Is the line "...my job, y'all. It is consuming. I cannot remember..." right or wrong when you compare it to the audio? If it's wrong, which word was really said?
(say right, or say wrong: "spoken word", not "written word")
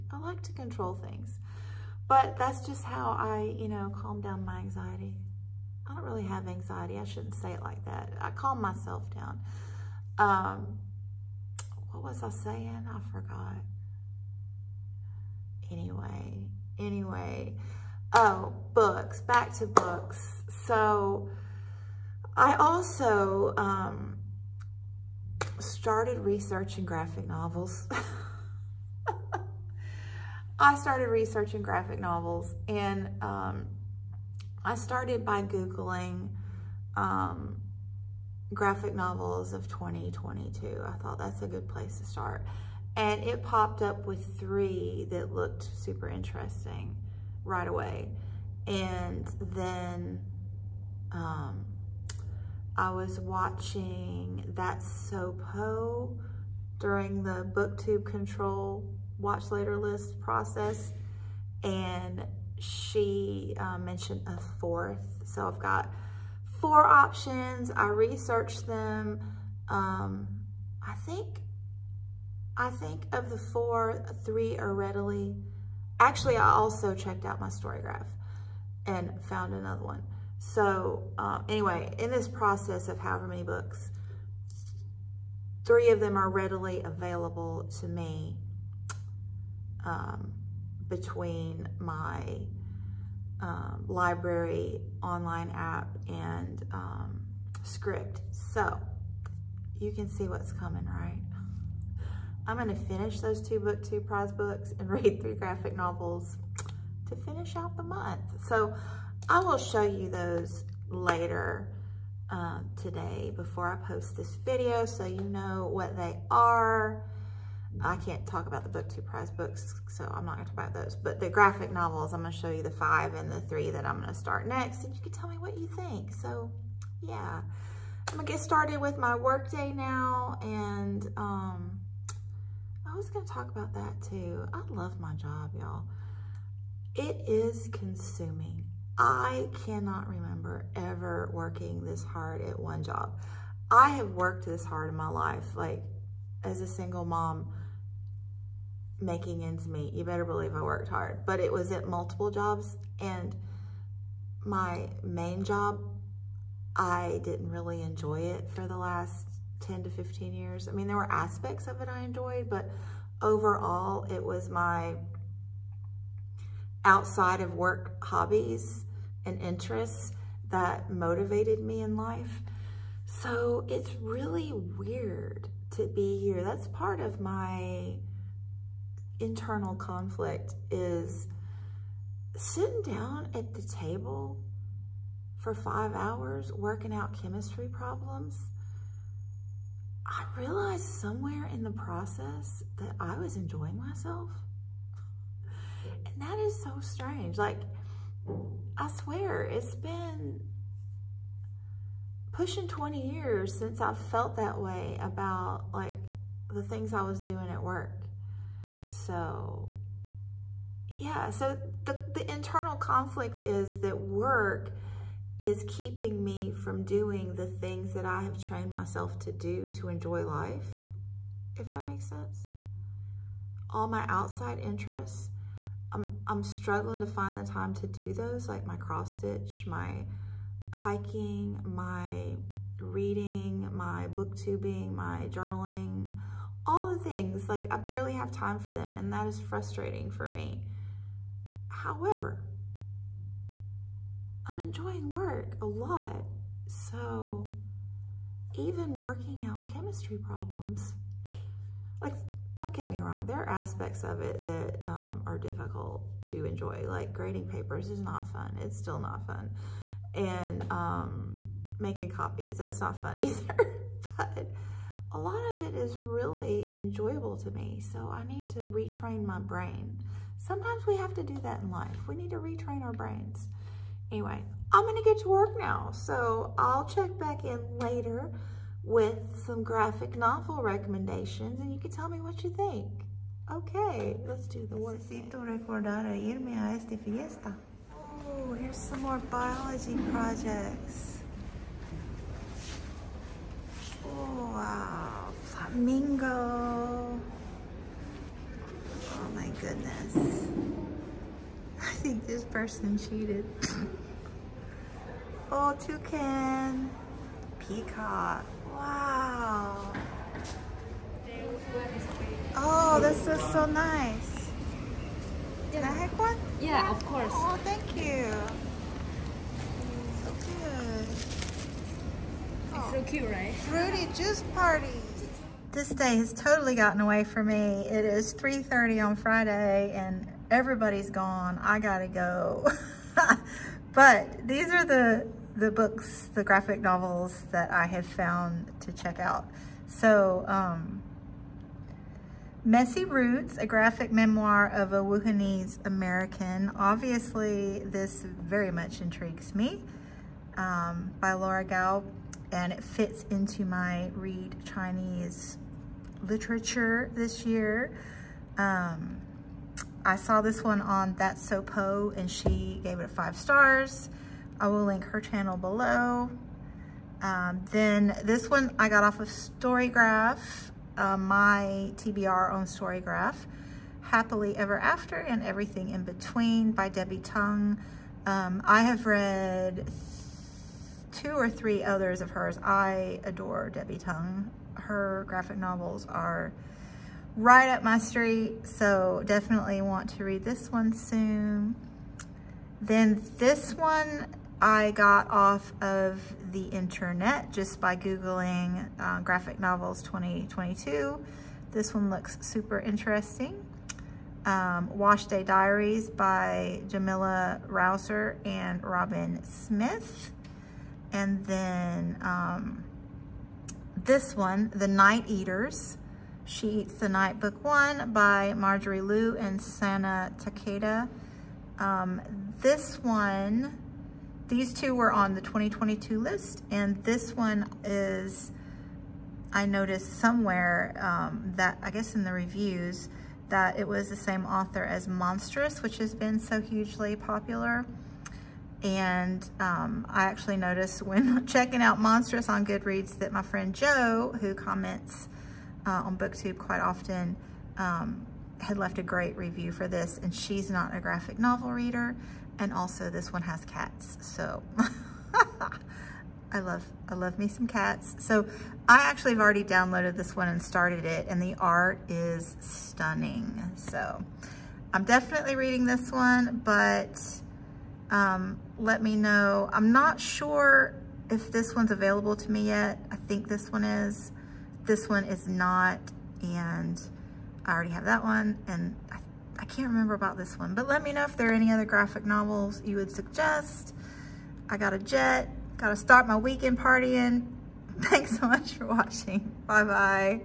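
right.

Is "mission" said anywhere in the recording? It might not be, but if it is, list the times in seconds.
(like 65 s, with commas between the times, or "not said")
not said.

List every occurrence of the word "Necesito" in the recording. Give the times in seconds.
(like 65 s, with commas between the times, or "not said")
285 s.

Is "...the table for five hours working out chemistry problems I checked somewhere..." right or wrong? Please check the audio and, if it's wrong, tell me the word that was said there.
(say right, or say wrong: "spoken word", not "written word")
wrong: "realized", not "checked".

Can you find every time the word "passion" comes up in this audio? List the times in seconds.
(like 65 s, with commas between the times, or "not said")
not said.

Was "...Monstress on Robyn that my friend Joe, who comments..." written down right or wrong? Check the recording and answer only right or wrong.
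wrong.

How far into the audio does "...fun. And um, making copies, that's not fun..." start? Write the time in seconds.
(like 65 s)
259 s.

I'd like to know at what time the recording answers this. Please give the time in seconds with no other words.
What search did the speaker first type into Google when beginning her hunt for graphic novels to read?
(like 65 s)
38 s.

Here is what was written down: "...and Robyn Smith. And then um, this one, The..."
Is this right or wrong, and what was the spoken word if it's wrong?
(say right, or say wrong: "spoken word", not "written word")
right.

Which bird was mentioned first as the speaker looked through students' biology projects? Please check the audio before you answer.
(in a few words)
Flamingo.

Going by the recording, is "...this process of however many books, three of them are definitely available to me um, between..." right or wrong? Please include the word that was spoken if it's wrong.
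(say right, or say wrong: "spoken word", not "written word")
wrong: "readily", not "definitely".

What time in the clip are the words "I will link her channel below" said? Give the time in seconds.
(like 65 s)
364 s.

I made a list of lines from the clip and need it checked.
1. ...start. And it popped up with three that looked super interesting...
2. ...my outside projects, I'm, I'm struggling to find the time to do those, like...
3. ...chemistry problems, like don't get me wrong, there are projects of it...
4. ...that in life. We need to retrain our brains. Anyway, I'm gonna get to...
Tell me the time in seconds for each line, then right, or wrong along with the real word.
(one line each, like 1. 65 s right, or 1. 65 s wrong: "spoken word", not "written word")
1. 42 s right
2. 223 s wrong: "interests", not "projects"
3. 249 s wrong: "aspects", not "projects"
4. 271 s right.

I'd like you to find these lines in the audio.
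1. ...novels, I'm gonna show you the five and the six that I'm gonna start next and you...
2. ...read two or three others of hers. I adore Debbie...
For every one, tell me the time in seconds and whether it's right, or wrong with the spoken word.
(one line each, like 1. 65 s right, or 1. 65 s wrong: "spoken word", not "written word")
1. 121 s wrong: "three", not "six"
2. 379 s right.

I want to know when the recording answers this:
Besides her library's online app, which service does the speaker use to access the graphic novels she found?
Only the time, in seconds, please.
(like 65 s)
97 s.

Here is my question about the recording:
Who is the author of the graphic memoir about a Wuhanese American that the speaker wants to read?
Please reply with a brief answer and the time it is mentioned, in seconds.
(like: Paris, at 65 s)
Laura Gao, at 351 s.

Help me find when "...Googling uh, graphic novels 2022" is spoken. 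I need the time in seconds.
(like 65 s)
397 s.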